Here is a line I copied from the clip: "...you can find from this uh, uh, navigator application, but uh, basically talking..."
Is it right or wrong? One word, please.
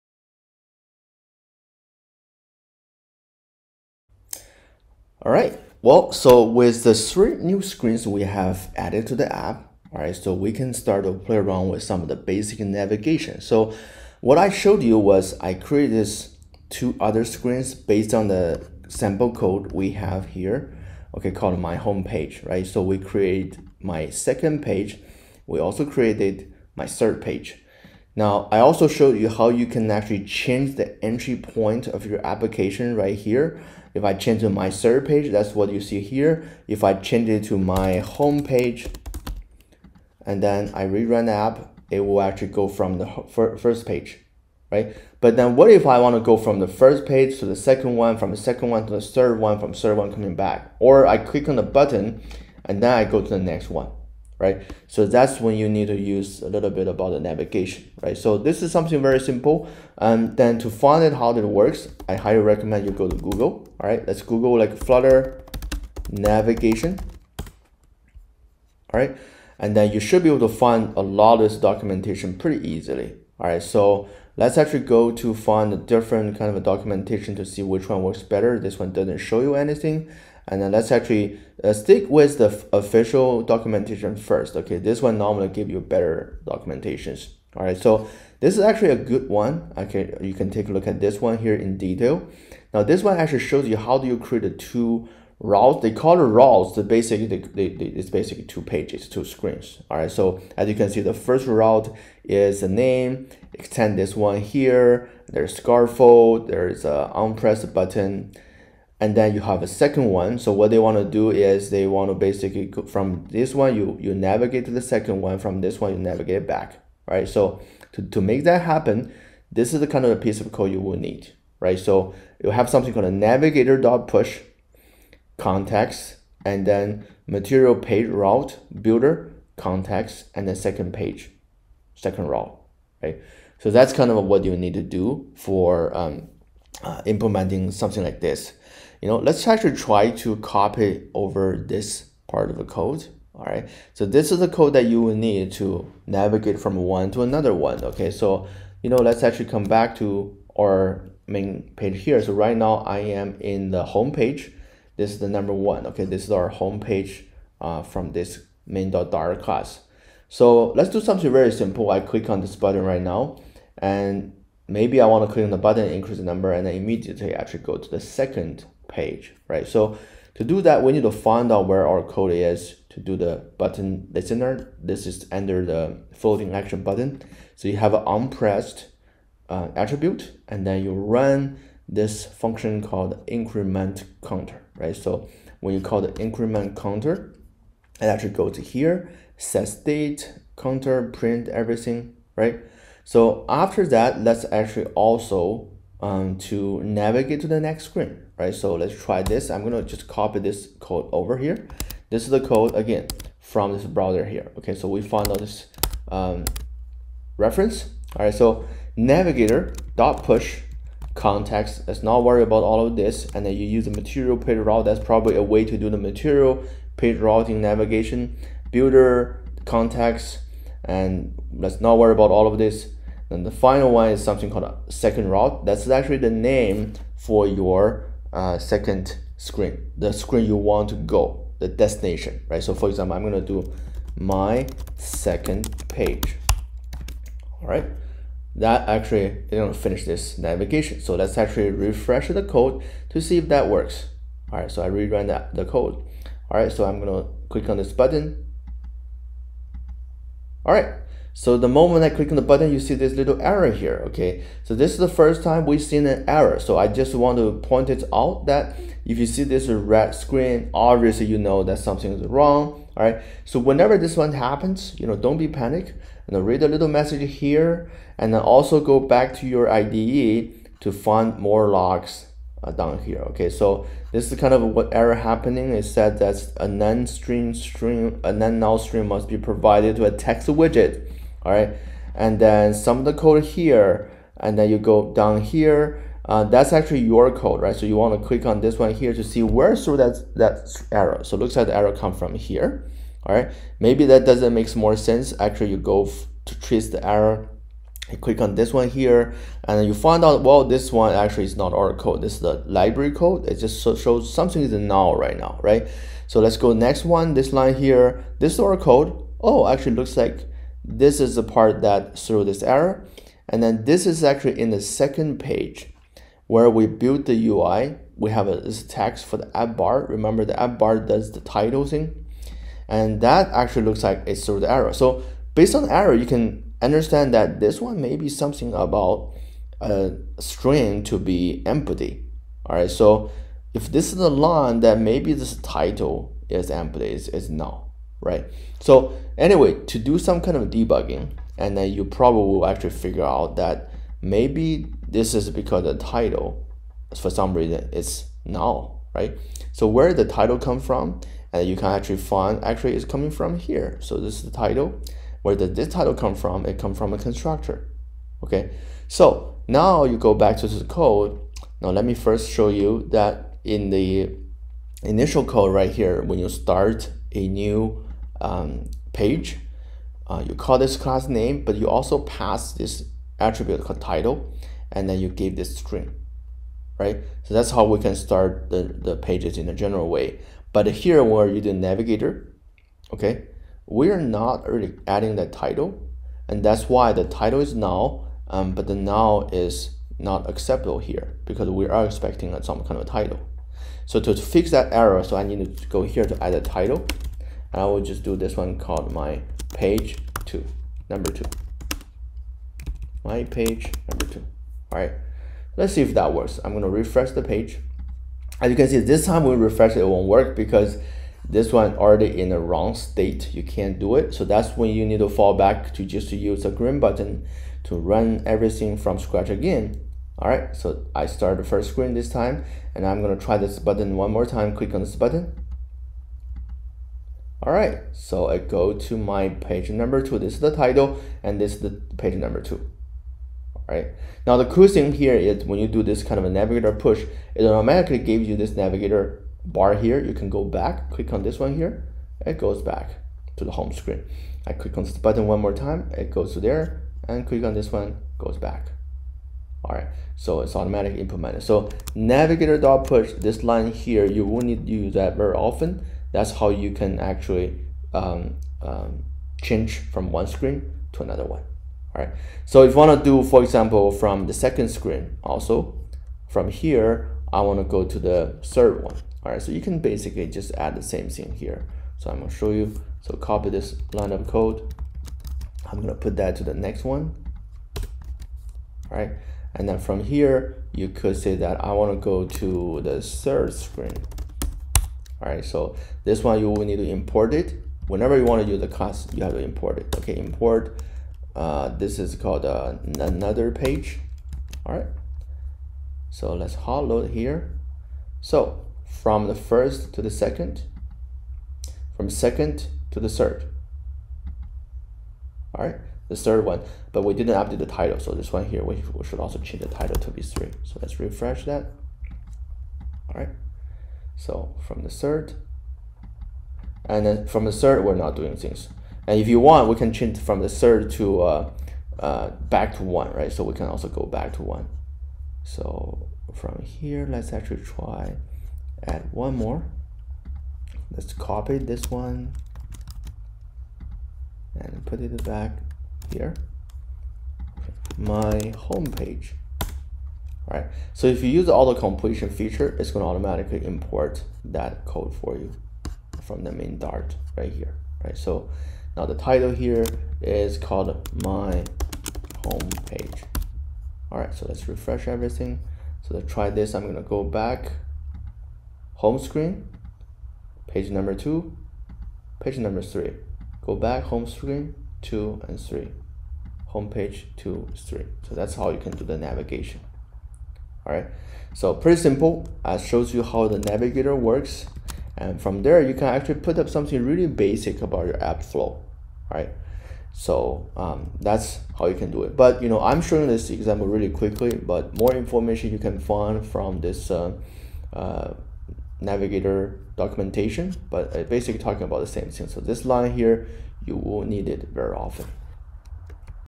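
wrong.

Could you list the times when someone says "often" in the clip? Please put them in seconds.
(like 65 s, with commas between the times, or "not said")
455 s, 595 s.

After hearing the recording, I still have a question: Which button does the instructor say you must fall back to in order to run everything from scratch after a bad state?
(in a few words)
the green button.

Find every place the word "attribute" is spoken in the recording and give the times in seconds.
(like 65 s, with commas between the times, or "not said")
179 s, 373 s.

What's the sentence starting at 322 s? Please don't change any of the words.
And that actually looks like it threw the error.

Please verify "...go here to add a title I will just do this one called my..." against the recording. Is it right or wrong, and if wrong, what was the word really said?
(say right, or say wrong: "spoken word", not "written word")
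right.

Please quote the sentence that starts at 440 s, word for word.
You can go back, click on this one here.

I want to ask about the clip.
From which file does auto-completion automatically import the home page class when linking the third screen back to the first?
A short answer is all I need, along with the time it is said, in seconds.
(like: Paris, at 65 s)
main.dart, at 546 s.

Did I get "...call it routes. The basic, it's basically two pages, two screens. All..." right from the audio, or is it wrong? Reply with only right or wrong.
right.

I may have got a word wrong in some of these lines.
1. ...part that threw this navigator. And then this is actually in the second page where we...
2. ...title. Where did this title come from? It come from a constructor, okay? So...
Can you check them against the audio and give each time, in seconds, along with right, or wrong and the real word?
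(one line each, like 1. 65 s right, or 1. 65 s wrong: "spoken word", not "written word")
1. 311 s wrong: "error", not "navigator"
2. 354 s right.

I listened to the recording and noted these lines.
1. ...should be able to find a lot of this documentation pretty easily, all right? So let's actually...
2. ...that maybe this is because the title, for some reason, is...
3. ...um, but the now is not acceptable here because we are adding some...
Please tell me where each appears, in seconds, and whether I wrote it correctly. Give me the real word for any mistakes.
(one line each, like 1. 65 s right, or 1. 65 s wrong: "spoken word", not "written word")
1. 69 s right
2. 343 s right
3. 388 s wrong: "expecting", not "adding".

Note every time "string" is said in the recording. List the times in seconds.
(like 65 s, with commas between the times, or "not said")
278 s, 330 s, 375 s.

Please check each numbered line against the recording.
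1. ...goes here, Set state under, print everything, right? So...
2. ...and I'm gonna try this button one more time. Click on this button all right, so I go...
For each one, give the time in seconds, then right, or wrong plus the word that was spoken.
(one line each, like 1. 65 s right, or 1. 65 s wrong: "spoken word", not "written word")
1. 188 s wrong: "counter", not "under"
2. 422 s right.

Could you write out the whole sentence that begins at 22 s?
So we create my second page.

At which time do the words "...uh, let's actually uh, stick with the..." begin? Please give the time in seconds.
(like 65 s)
80 s.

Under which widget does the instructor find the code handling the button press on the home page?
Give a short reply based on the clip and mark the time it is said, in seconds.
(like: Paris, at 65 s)
floating action button, at 176 s.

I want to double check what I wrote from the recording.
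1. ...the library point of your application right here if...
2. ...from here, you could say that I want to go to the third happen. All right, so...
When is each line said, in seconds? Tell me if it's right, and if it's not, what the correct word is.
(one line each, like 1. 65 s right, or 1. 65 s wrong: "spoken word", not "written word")
1. 30 s wrong: "entry", not "library"
2. 479 s wrong: "screen", not "happen".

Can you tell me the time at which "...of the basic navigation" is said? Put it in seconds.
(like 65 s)
12 s.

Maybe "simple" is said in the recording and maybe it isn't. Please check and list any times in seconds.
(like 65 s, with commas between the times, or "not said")
59 s, 161 s, 572 s.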